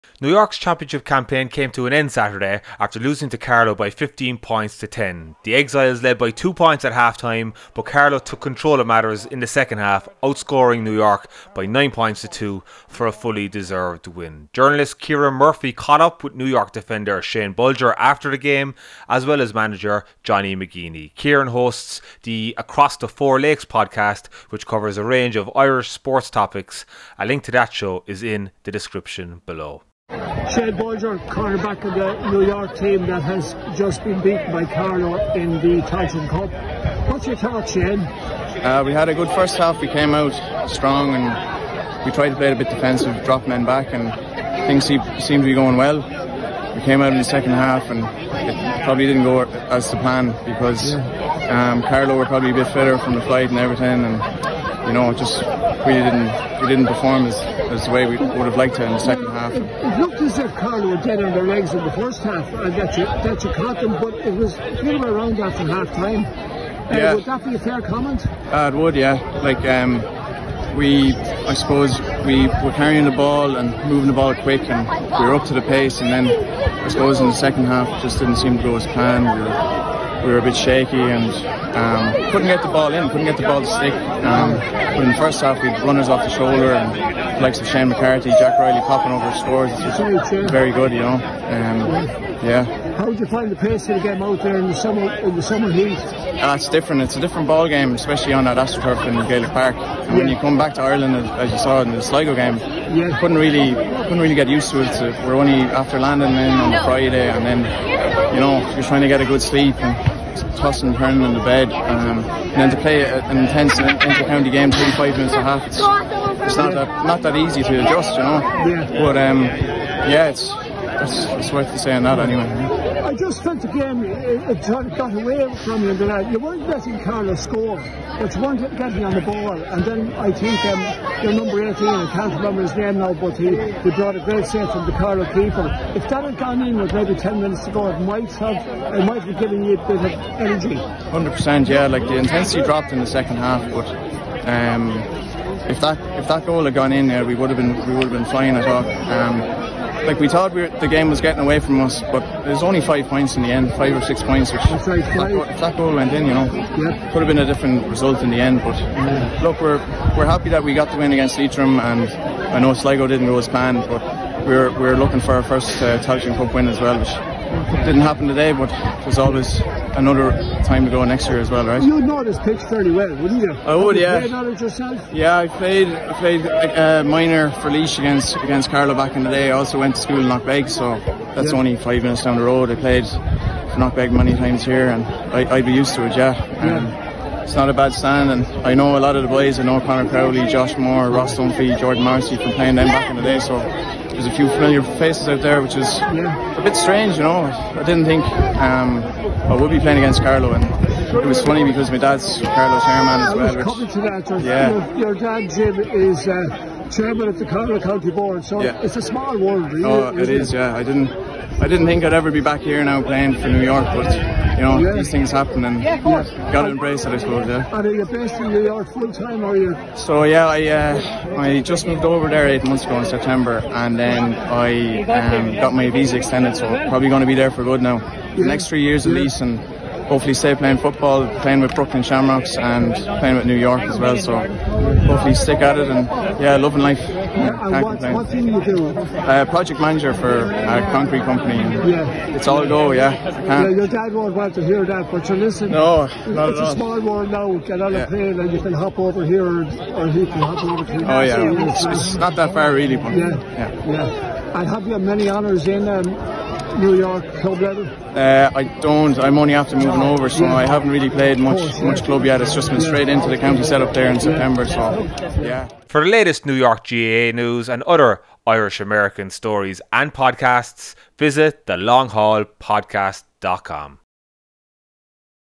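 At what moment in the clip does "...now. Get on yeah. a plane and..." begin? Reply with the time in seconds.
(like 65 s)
247 s.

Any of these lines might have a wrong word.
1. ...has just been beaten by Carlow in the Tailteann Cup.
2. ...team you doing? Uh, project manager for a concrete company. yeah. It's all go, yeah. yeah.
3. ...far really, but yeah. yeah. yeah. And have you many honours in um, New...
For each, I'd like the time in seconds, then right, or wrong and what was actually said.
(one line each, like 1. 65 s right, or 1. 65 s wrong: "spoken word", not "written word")
1. 33 s right
2. 238 s right
3. 252 s right.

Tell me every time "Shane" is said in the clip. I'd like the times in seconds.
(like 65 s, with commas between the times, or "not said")
17 s, 37 s, 87 s.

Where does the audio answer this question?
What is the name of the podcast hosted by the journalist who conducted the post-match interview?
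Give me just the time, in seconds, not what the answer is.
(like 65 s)
22 s.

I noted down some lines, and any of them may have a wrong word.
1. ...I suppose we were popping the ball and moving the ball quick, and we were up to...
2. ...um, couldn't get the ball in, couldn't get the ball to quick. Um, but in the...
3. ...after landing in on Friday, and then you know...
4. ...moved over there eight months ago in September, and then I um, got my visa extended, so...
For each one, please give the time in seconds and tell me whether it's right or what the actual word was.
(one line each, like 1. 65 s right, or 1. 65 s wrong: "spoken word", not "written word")
1. 71 s wrong: "carrying", not "popping"
2. 81 s wrong: "stick", not "quick"
3. 105 s right
4. 221 s right.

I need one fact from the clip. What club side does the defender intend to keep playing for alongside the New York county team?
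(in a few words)
Brooklyn Shamrocks.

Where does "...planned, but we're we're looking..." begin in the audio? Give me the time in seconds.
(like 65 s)
163 s.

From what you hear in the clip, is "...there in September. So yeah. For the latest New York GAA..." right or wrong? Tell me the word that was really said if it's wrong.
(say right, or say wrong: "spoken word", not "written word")
right.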